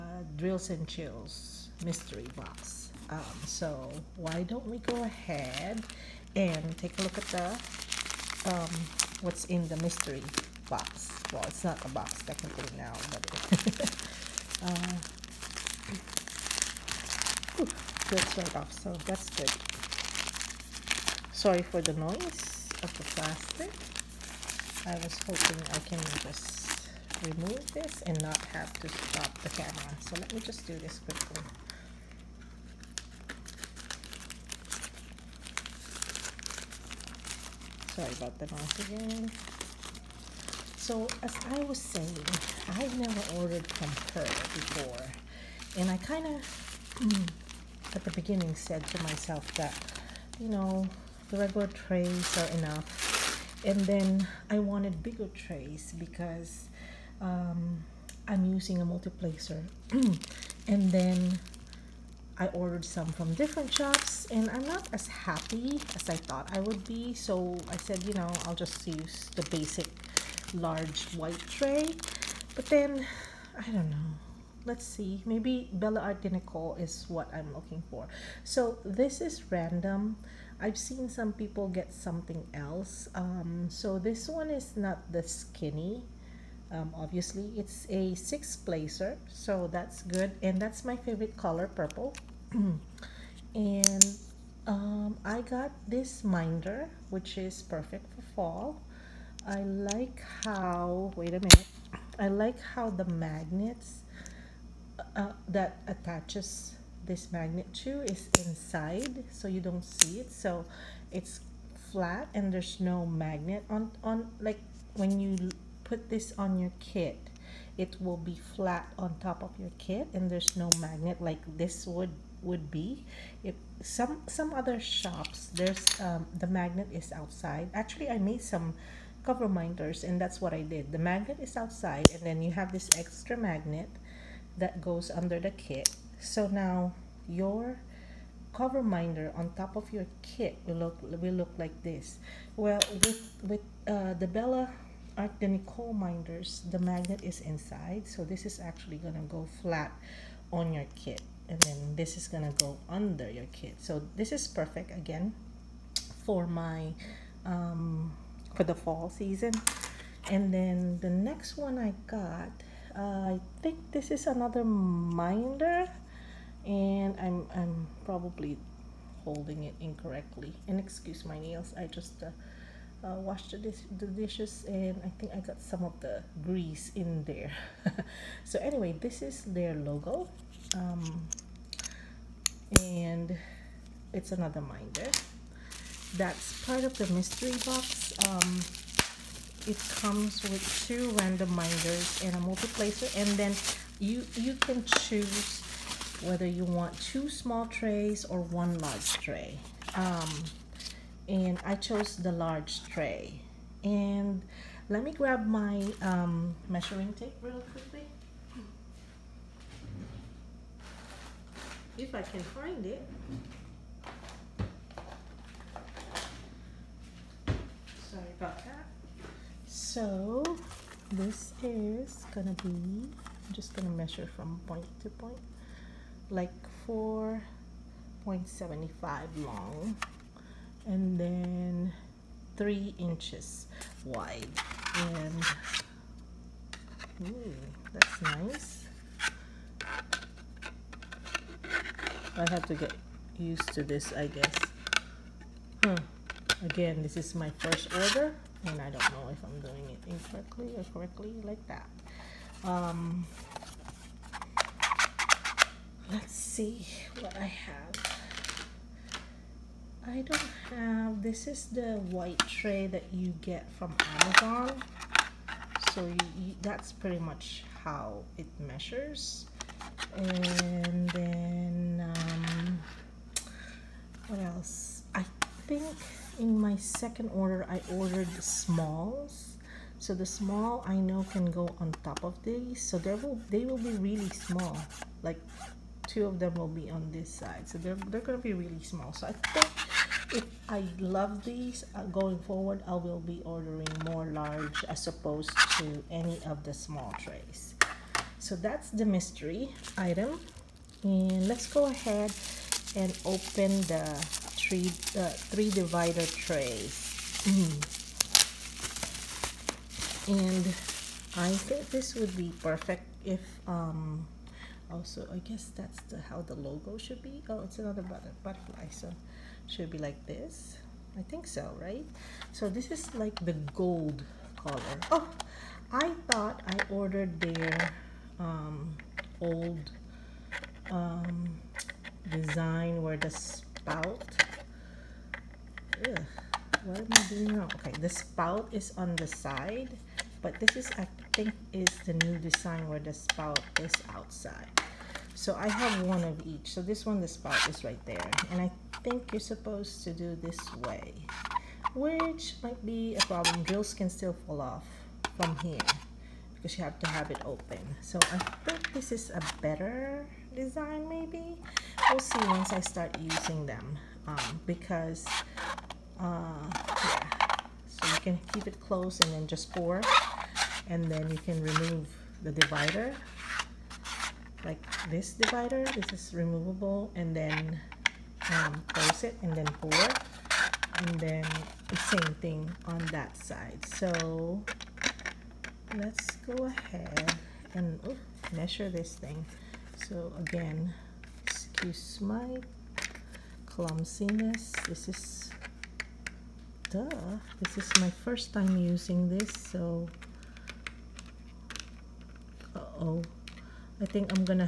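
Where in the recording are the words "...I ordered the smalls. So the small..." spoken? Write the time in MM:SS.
04:37.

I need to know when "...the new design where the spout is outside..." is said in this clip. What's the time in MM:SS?
05:42.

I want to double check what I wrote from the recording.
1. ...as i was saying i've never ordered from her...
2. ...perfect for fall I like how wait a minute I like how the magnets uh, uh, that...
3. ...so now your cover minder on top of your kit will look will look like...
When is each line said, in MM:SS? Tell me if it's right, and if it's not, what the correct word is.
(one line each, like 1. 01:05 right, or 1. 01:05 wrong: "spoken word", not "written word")
1. 00:41 right
2. 01:37 right
3. 02:16 right.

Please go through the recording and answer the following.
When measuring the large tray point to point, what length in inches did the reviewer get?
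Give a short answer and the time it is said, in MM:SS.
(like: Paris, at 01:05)
4.75, at 03:46.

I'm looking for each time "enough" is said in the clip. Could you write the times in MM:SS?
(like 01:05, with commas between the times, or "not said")
00:52.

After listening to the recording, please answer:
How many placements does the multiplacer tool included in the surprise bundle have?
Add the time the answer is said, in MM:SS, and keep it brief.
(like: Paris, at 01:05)
6, at 01:28.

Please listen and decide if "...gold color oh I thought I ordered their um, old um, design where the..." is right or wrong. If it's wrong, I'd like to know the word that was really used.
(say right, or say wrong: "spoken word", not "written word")
right.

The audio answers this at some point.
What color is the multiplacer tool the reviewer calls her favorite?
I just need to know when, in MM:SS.
01:31.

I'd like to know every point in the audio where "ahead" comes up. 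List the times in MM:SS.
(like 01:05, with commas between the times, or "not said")
00:05, 05:01, 06:26.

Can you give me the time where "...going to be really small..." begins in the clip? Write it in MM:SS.
04:48.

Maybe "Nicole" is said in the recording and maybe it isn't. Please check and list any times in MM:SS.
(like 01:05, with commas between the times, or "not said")
01:16, 02:25.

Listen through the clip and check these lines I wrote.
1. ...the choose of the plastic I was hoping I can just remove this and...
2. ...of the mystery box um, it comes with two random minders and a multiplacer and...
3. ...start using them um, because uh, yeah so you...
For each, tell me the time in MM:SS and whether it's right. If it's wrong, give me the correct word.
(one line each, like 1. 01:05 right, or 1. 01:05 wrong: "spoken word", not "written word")
1. 00:21 wrong: "noise", not "choose"
2. 03:06 right
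3. 06:02 right.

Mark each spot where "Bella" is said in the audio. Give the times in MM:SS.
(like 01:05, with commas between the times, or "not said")
01:15, 02:24.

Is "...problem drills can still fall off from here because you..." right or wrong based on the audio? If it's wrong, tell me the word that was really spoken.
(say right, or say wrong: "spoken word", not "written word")
right.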